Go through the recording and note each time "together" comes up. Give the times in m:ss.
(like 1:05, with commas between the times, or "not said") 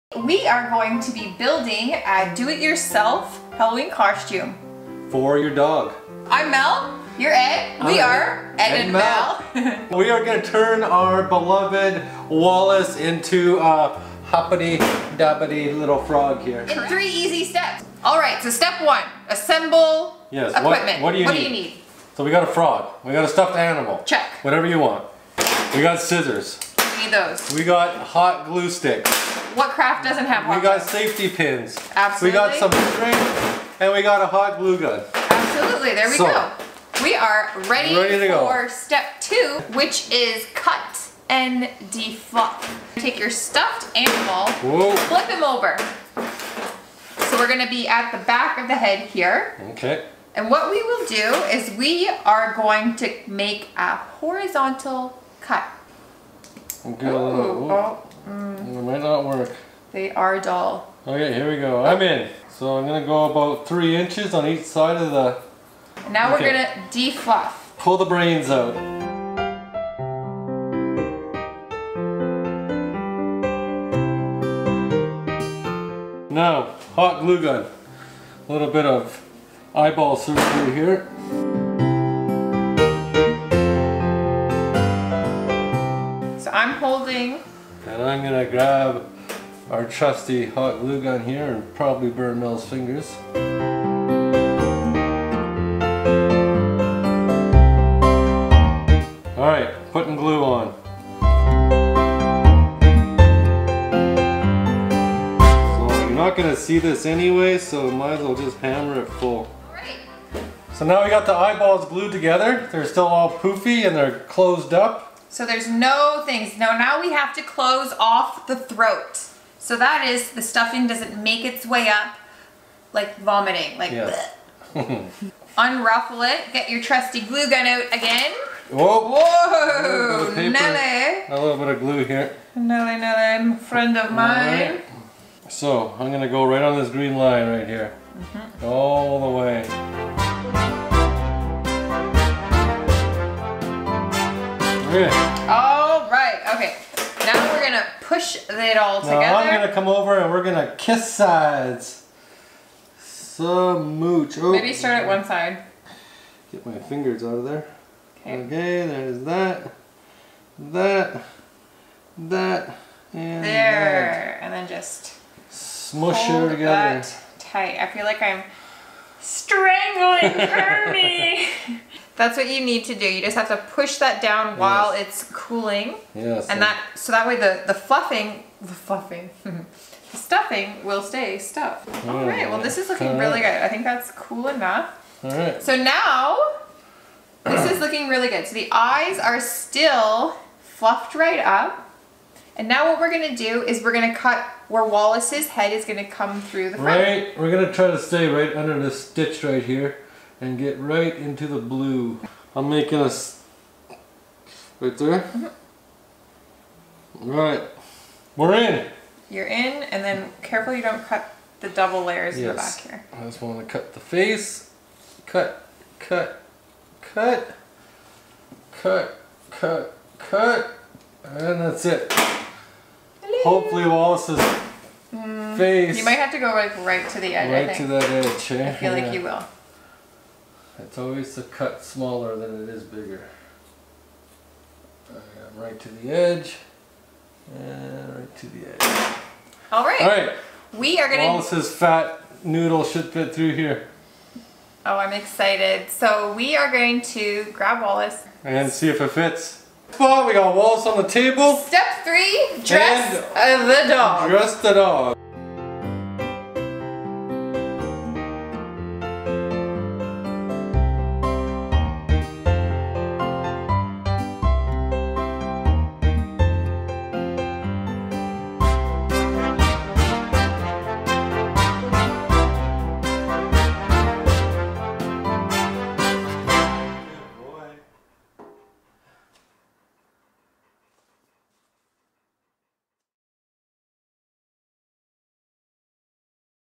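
1:52, 2:28, 2:46.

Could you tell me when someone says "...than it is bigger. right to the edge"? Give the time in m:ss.
3:52.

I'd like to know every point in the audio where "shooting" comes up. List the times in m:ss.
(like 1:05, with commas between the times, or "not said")
not said.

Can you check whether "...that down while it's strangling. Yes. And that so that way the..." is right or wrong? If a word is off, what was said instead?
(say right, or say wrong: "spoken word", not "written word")
wrong: "cooling", not "strangling".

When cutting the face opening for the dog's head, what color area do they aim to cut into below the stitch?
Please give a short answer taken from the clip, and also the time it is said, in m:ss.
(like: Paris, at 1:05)
blue, at 3:21.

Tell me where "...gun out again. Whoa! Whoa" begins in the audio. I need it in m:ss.
2:07.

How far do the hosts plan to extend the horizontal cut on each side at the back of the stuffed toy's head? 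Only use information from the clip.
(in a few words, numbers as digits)
3 inches.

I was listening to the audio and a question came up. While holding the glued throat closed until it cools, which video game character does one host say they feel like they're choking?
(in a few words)
Kirby.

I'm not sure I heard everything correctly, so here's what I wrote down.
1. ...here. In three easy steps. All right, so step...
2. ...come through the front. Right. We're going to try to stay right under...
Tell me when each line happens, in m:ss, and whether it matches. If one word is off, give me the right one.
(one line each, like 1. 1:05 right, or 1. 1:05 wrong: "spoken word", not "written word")
1. 0:16 right
2. 3:16 right.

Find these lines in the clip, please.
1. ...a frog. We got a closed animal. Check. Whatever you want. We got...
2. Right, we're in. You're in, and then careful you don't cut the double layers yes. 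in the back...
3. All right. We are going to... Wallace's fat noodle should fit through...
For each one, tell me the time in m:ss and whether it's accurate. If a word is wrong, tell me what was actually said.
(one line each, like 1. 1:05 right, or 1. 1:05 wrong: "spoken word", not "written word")
1. 0:22 wrong: "stuffed", not "closed"
2. 3:27 right
3. 4:00 right.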